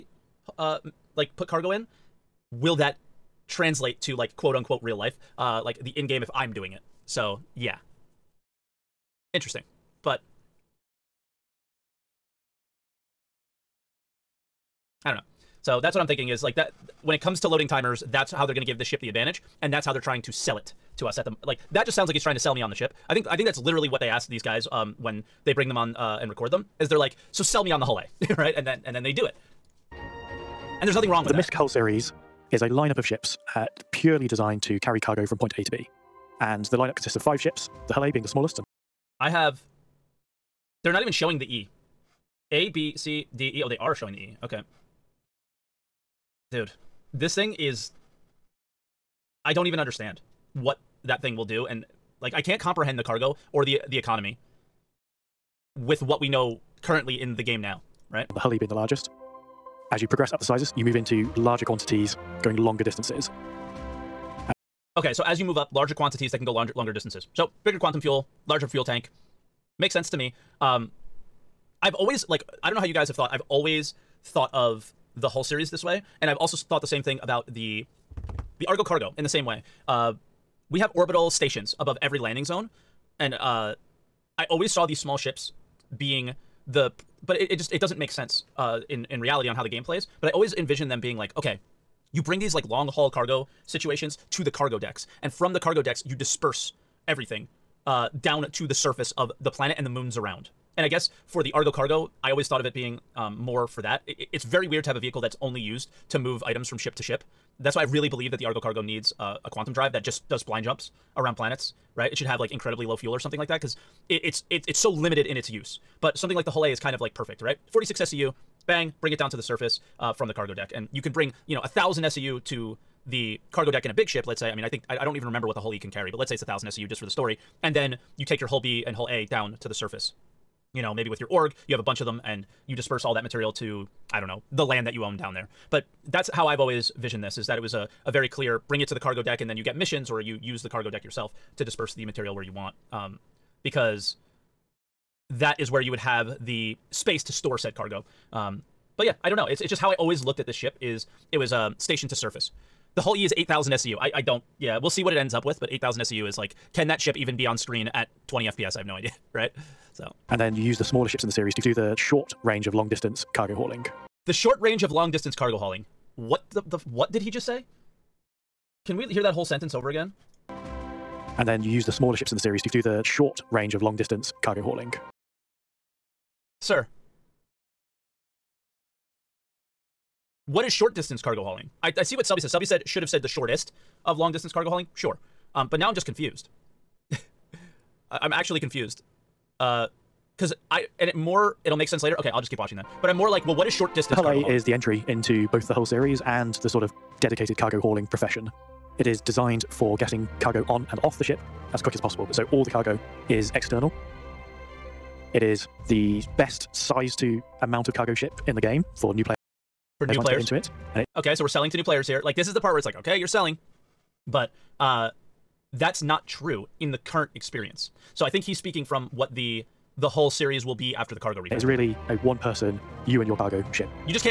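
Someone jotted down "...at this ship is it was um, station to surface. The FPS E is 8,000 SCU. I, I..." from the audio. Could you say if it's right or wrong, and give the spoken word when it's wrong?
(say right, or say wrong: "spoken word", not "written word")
wrong: "Hull", not "FPS".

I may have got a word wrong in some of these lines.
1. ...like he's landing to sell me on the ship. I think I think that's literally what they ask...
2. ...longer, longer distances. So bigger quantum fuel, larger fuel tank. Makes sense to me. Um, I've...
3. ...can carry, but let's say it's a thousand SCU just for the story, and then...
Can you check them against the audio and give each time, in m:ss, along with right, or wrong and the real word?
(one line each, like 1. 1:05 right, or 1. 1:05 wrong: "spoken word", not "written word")
1. 0:22 wrong: "trying", not "landing"
2. 1:06 right
3. 2:05 right.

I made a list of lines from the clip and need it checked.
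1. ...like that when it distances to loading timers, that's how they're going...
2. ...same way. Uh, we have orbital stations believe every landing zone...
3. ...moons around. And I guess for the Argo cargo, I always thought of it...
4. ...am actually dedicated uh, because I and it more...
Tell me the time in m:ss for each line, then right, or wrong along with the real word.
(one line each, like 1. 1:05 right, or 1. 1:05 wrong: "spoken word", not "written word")
1. 0:16 wrong: "comes", not "distances"
2. 1:19 wrong: "above", not "believe"
3. 1:39 right
4. 3:08 wrong: "confused", not "dedicated".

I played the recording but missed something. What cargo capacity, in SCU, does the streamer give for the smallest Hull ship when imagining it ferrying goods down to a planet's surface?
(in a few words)
46 SCU.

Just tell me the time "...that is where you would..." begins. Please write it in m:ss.
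2:25.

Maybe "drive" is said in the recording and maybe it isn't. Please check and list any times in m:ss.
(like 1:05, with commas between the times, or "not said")
1:49.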